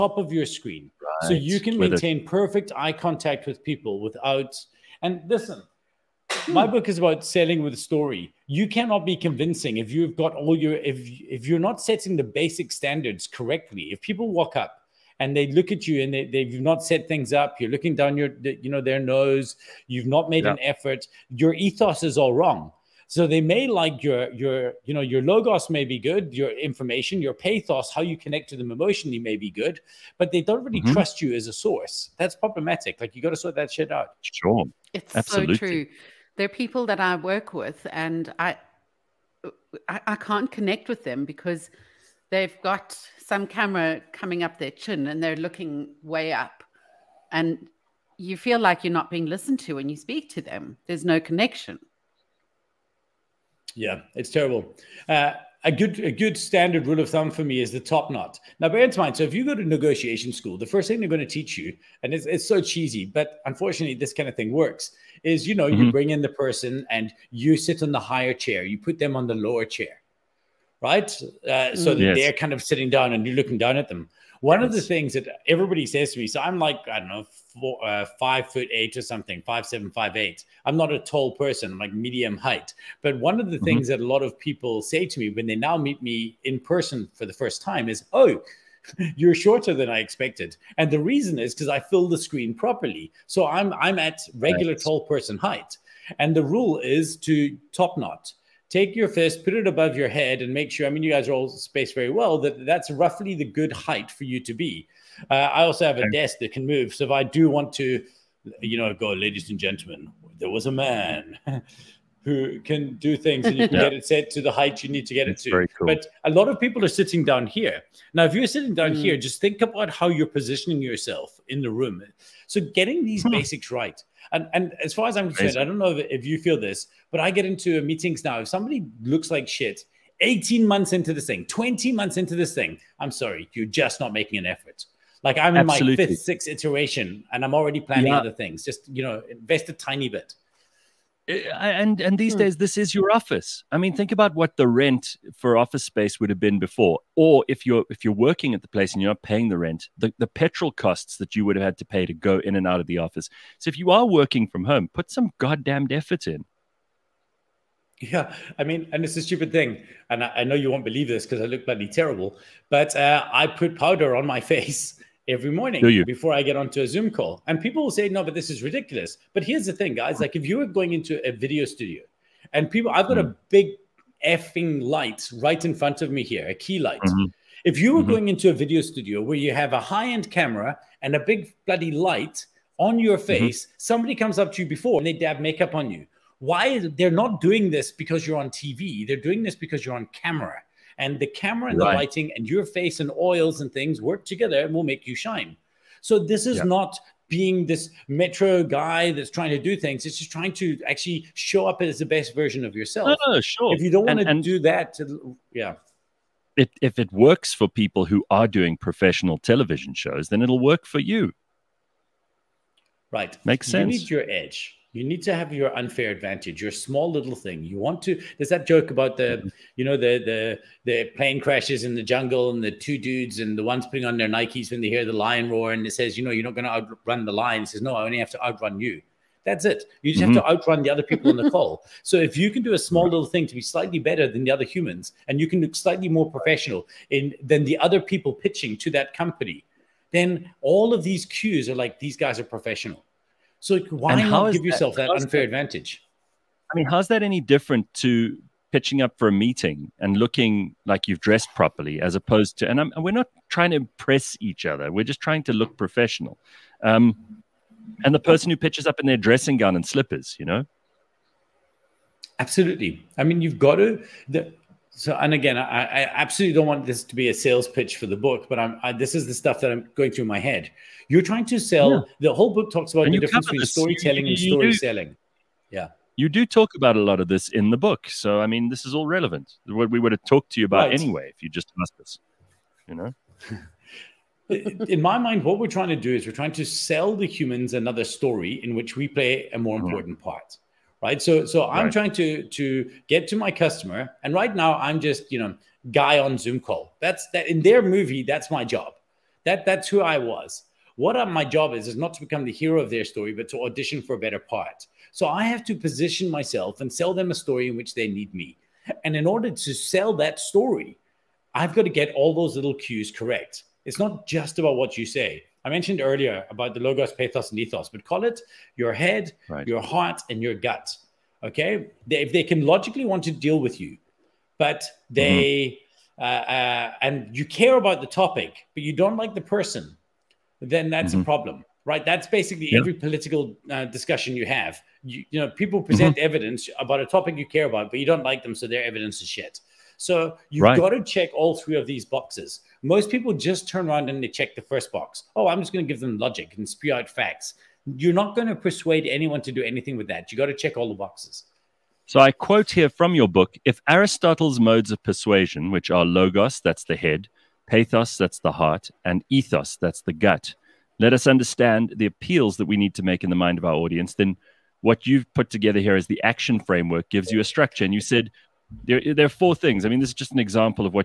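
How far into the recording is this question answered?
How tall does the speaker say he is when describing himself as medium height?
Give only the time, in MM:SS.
01:18.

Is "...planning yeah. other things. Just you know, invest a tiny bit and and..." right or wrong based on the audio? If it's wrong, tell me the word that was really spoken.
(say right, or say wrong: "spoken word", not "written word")
right.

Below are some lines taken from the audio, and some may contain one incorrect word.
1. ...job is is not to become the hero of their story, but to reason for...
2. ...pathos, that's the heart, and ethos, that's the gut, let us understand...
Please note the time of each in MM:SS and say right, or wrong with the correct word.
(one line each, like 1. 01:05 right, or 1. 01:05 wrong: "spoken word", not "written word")
1. 05:01 wrong: "audition", not "reason"
2. 05:57 right.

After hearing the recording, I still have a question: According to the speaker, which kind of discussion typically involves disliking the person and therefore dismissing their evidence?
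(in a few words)
political.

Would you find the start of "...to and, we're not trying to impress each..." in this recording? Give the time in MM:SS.
04:12.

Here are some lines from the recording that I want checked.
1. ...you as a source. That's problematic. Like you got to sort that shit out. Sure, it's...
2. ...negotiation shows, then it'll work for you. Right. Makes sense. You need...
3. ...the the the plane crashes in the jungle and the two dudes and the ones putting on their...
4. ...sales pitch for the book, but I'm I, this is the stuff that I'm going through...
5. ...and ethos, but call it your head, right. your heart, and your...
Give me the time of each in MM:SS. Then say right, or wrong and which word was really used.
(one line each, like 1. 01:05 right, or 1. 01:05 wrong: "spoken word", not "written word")
1. 00:31 right
2. 03:29 wrong: "television", not "negotiation"
3. 03:39 right
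4. 04:27 right
5. 05:17 right.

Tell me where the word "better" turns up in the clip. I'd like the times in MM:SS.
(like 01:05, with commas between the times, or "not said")
03:53, 05:04.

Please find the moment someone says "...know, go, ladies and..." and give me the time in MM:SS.
01:48.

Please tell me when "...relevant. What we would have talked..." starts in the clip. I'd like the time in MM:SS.
04:39.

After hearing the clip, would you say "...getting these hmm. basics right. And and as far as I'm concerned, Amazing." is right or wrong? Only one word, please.
right.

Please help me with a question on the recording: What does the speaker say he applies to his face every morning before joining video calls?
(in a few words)
powder.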